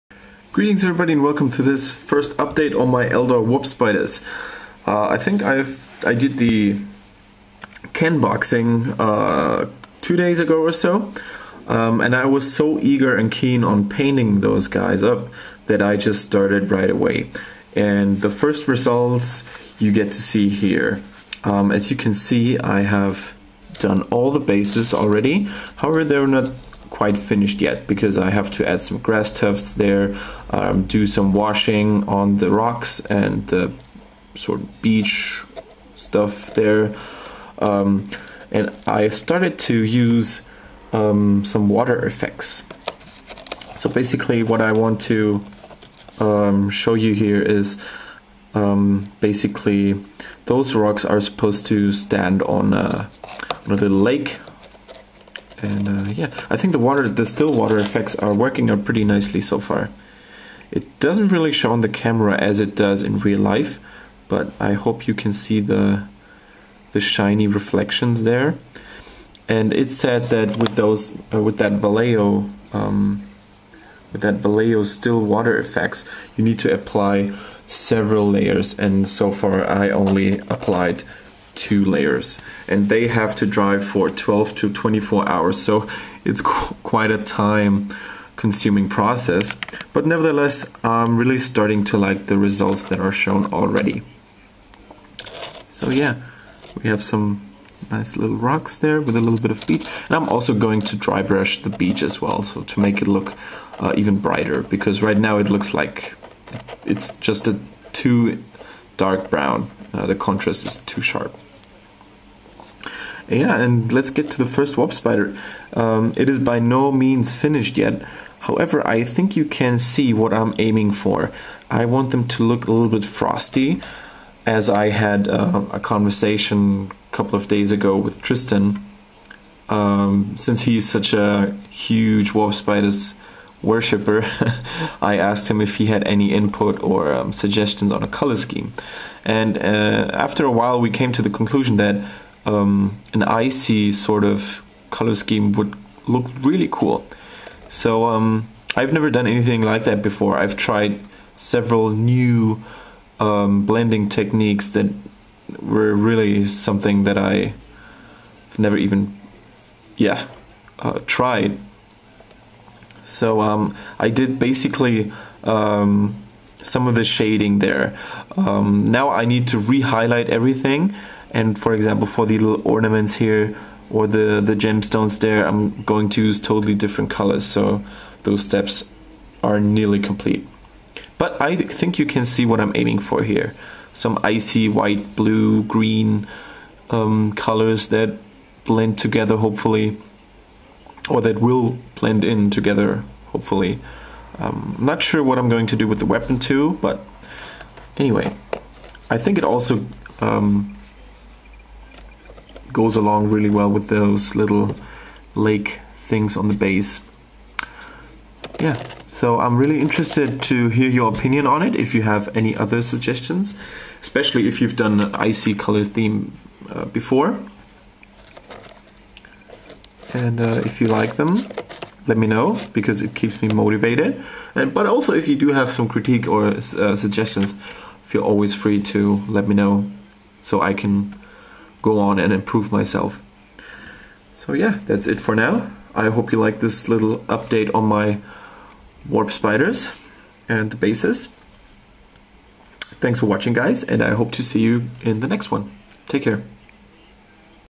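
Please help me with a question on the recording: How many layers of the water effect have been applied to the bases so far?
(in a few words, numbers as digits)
2.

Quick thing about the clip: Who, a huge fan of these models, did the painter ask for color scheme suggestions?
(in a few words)
Tristan.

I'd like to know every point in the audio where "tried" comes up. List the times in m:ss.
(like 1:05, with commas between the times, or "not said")
2:30, 2:41.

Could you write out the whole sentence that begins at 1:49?
Uh, the contrast is too sharp.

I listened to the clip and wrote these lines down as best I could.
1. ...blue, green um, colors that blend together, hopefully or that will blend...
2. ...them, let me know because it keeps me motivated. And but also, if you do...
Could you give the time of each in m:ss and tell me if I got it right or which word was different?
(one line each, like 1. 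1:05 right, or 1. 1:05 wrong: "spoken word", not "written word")
1. 3:05 right
2. 3:41 right.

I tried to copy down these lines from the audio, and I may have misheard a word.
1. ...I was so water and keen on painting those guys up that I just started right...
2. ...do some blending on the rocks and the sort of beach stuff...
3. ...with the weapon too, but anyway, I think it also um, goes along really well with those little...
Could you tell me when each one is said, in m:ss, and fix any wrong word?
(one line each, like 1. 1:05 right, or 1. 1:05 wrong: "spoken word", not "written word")
1. 0:12 wrong: "eager", not "water"
2. 0:30 wrong: "washing", not "blending"
3. 3:15 right.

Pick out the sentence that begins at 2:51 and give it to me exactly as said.
And for example, for the little ornaments here or the, the gemstones there, I'm going to use totally different colors.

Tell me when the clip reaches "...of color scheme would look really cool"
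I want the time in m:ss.
2:24.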